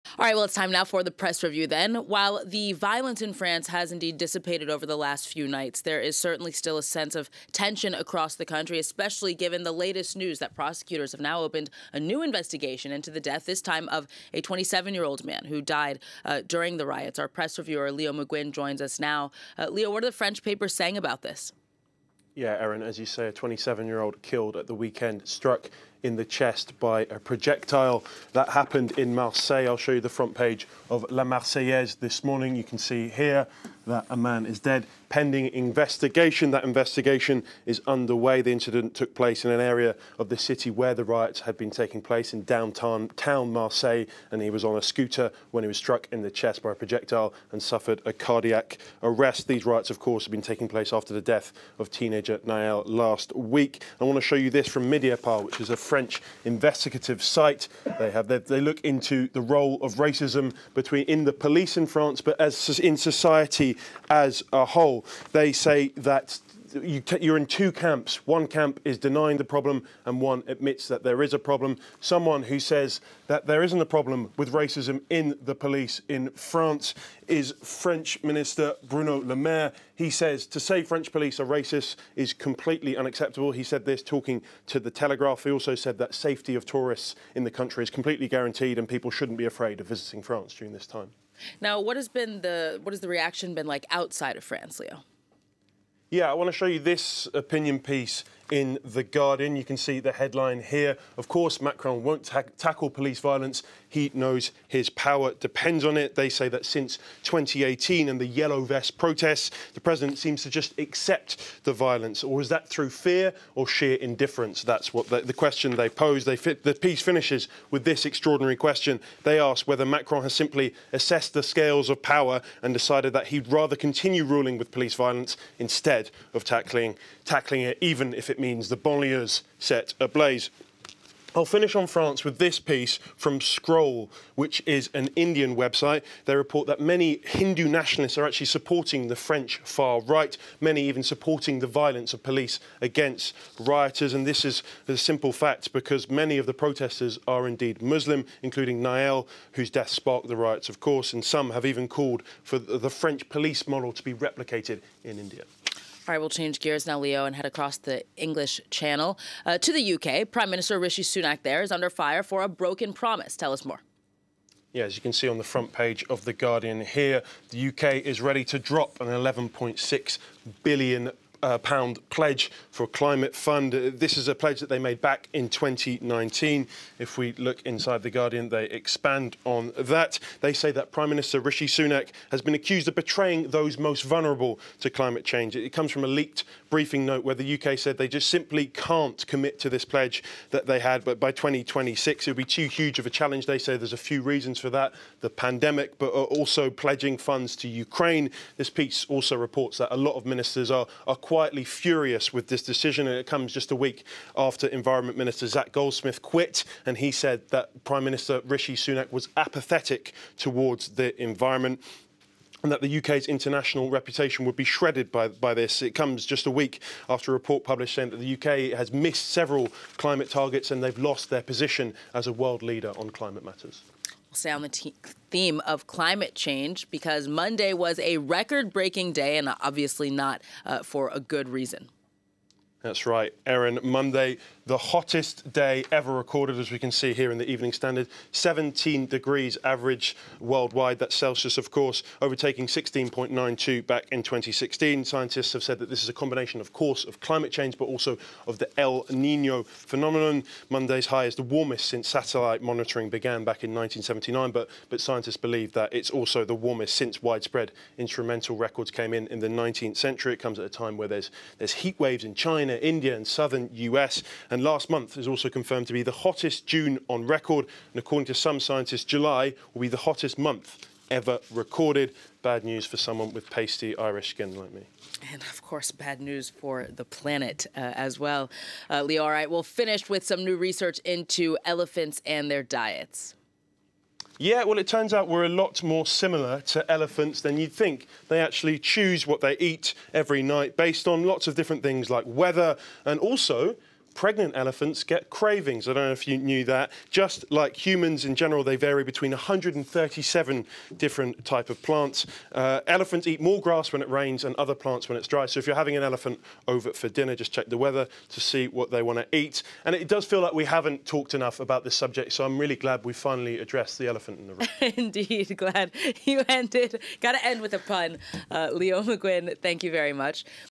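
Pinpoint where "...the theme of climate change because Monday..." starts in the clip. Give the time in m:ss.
3:44.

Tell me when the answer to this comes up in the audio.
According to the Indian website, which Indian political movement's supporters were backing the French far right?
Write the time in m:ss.
2:17.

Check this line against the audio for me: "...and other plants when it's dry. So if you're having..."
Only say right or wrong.
right.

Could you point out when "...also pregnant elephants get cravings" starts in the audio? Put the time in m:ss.
4:53.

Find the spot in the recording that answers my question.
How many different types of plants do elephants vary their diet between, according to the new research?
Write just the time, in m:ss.
4:59.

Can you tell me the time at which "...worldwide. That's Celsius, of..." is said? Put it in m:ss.
4:00.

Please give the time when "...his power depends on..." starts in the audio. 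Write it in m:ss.
1:44.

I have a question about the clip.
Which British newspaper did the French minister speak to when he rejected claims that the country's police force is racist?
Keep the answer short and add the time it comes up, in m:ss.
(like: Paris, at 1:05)
The Telegraph, at 1:24.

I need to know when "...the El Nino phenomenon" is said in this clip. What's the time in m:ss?
4:08.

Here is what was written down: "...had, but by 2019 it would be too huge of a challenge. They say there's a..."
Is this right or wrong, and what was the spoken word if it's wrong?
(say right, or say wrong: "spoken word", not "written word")
wrong: "2026", not "2019".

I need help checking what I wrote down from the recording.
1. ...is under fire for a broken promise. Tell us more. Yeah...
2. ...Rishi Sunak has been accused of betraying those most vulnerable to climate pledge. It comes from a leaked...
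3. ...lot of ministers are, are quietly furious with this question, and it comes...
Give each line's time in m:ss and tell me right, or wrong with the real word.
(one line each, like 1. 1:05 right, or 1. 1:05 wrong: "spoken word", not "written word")
1. 2:41 right
2. 3:01 wrong: "change", not "pledge"
3. 3:19 wrong: "decision", not "question".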